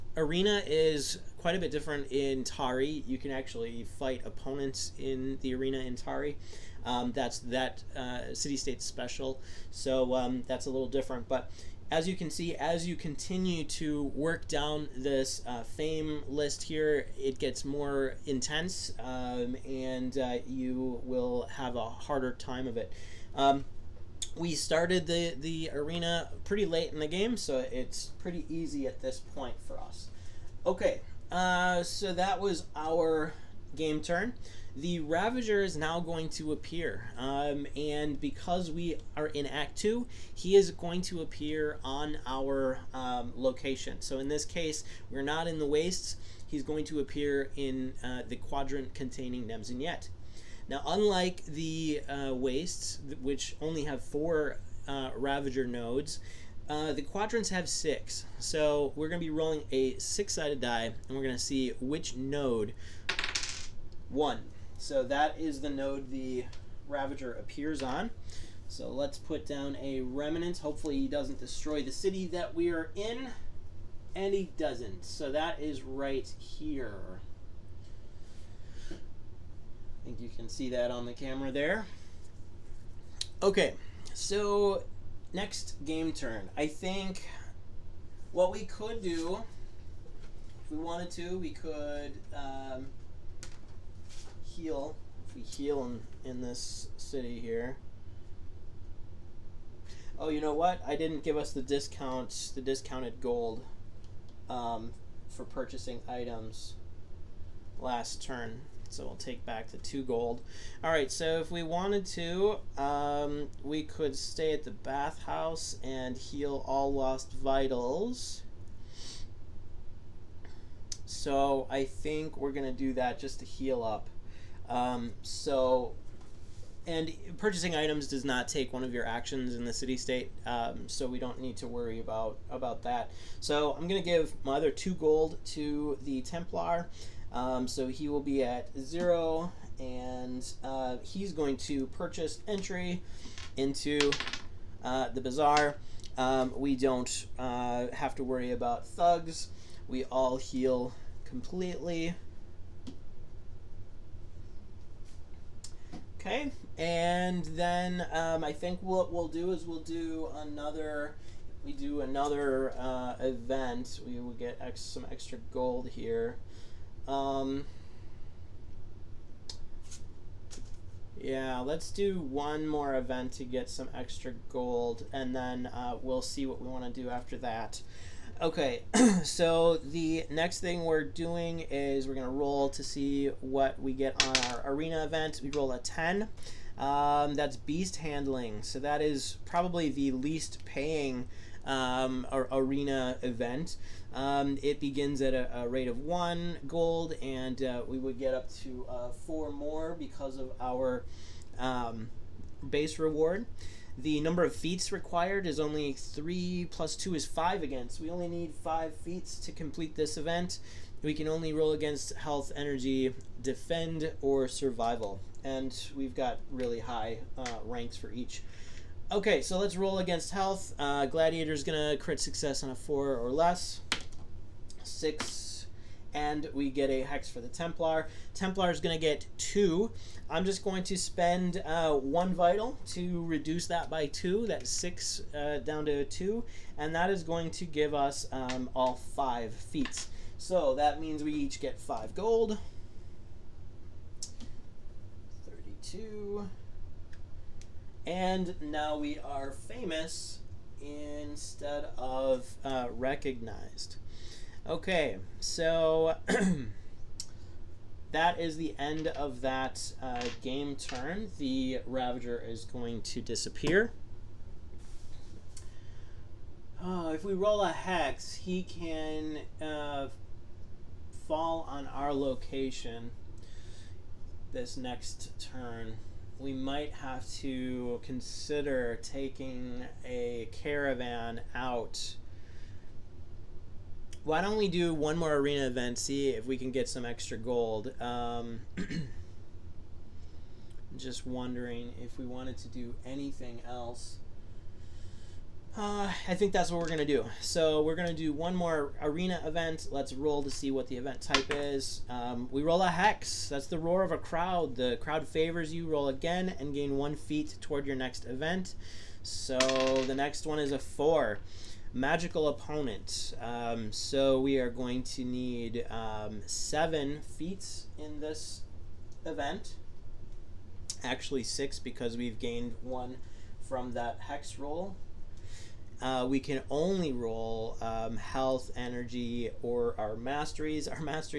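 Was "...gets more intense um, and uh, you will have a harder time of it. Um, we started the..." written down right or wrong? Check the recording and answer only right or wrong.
right.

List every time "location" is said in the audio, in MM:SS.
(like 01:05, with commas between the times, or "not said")
00:43, 04:32.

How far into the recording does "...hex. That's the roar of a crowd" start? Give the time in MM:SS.
05:02.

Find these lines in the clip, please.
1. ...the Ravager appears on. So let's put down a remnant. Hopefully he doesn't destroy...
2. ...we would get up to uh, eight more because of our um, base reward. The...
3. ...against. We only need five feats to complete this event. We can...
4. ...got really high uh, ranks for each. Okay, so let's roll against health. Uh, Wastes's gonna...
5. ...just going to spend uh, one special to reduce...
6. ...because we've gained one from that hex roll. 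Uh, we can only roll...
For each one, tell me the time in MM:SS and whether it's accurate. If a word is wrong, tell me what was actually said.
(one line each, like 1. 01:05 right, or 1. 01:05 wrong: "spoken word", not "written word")
1. 01:06 right
2. 03:17 wrong: "four", not "eight"
3. 03:27 right
4. 03:36 wrong: "Gladiator", not "Wastes"
5. 03:50 wrong: "vital", not "special"
6. 05:21 right.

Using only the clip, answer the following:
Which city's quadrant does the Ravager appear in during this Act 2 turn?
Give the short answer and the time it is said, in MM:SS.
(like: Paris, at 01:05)
Nemsynet, at 00:49.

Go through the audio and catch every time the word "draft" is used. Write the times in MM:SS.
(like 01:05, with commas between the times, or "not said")
not said.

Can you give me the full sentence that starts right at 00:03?
You can actually fight opponents in the arena in Tari.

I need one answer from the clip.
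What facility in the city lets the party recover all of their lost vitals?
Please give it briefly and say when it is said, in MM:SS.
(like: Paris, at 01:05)
bathhouse, at 01:54.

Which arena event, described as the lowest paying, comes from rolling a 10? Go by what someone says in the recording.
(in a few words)
beast handling.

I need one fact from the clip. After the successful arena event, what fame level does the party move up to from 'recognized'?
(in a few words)
famous.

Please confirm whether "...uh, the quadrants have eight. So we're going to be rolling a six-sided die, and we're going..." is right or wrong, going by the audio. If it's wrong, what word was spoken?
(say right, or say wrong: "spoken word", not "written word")
wrong: "six", not "eight".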